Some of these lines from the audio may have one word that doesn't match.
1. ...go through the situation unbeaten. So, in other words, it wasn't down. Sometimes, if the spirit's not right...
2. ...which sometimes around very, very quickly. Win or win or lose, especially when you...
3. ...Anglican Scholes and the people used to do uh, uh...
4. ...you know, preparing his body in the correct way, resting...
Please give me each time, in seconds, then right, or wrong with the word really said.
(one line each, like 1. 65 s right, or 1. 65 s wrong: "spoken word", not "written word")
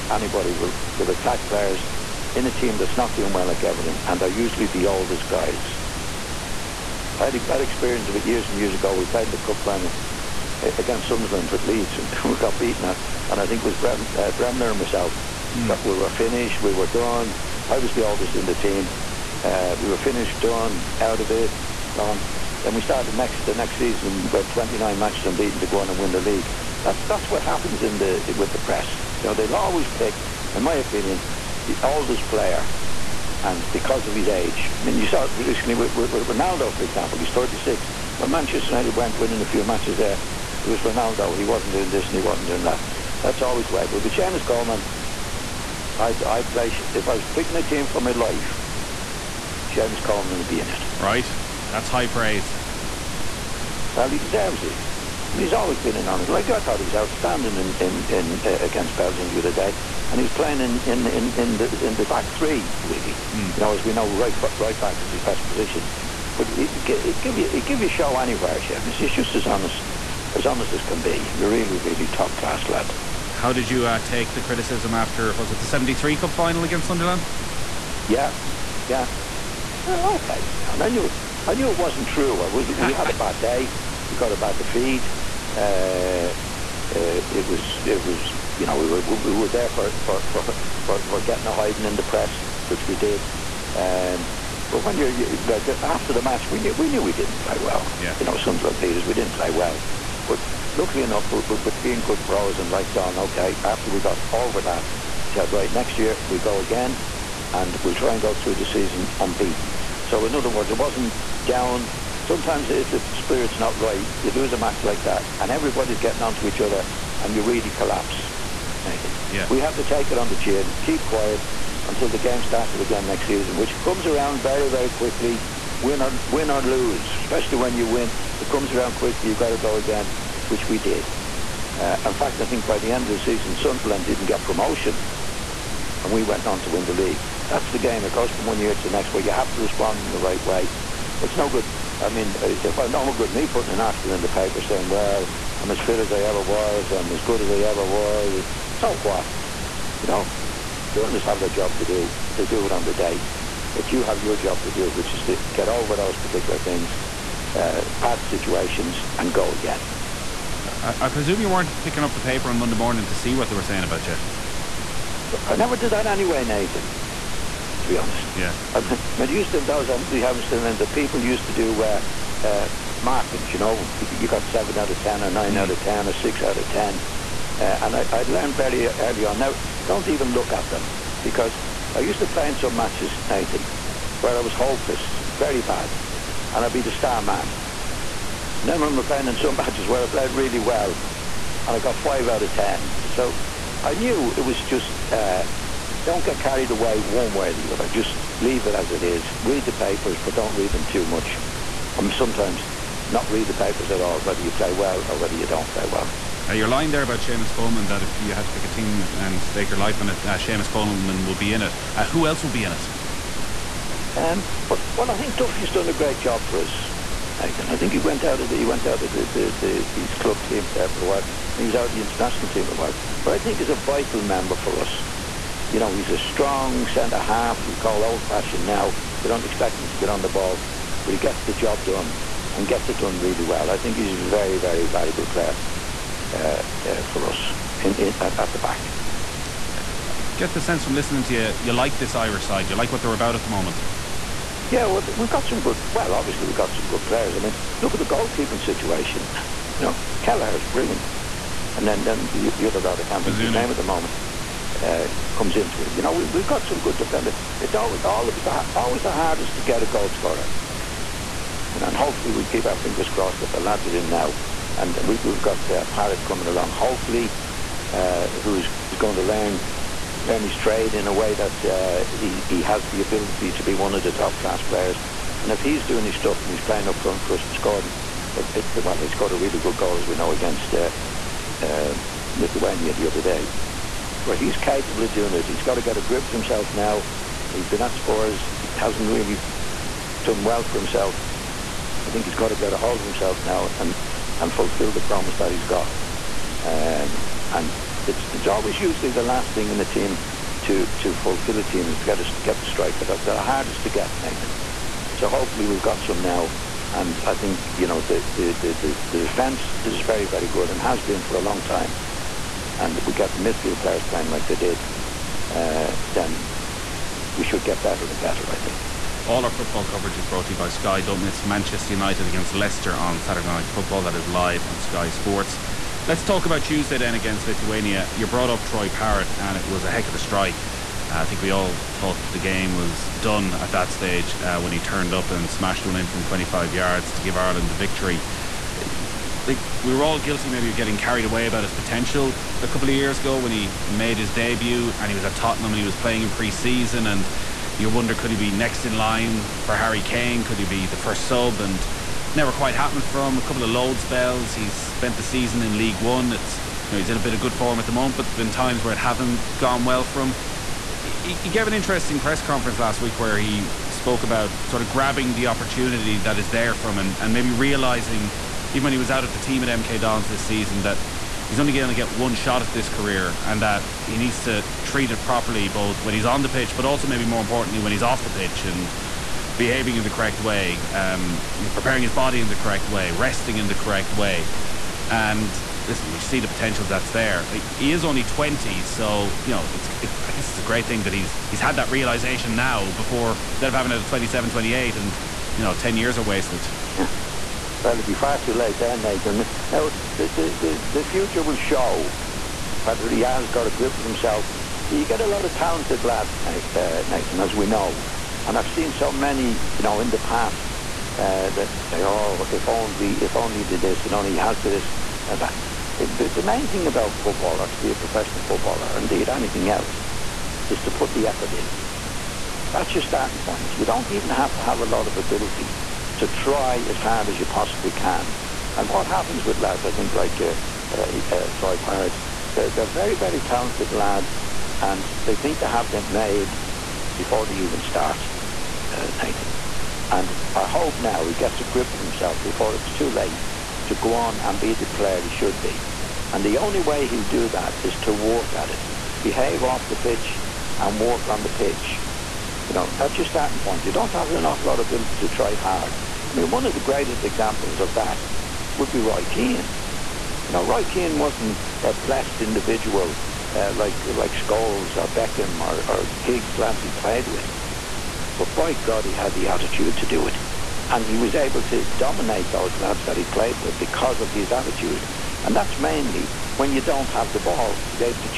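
1. 108 s wrong: "season", not "situation"
2. 123 s wrong: "comes", not "sometimes"
3. 169 s wrong: "Hamilton", not "Scholes"
4. 381 s right.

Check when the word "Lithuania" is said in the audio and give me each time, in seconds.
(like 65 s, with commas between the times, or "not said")
282 s, 327 s.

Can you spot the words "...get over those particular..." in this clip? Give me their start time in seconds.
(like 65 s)
155 s.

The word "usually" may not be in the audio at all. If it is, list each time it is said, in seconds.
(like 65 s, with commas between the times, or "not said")
4 s, 298 s.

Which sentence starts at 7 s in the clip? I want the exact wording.
I had, I had experience of it years and years ago.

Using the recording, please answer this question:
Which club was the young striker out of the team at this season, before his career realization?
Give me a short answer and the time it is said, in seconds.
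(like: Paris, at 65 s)
MK Dons, at 369 s.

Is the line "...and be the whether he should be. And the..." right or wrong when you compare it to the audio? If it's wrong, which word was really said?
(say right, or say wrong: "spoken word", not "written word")
wrong: "player", not "whether".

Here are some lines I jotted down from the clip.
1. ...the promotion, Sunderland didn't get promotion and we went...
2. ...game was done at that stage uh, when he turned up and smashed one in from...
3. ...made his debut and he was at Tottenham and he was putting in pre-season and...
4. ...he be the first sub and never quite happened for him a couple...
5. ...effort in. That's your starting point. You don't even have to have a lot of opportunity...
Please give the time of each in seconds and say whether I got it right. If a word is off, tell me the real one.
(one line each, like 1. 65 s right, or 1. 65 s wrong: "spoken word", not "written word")
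1. 133 s wrong: "season", not "promotion"
2. 332 s right
3. 343 s wrong: "playing", not "putting"
4. 350 s right
5. 421 s wrong: "ability", not "opportunity".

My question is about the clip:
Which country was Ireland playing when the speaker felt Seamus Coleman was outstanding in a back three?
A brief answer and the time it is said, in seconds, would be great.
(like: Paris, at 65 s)
Belgium, at 58 s.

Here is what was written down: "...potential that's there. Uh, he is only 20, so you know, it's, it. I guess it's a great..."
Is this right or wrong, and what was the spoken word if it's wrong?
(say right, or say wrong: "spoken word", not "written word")
right.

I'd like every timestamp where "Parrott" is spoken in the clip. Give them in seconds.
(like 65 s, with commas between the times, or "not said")
265 s, 328 s, 431 s.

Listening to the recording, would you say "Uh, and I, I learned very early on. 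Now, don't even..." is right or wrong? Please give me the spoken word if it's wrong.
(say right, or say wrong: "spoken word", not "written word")
right.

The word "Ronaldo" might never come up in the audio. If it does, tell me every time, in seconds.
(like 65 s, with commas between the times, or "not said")
36 s, 40 s.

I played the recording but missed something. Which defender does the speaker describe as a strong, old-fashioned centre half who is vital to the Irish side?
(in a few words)
Duffy.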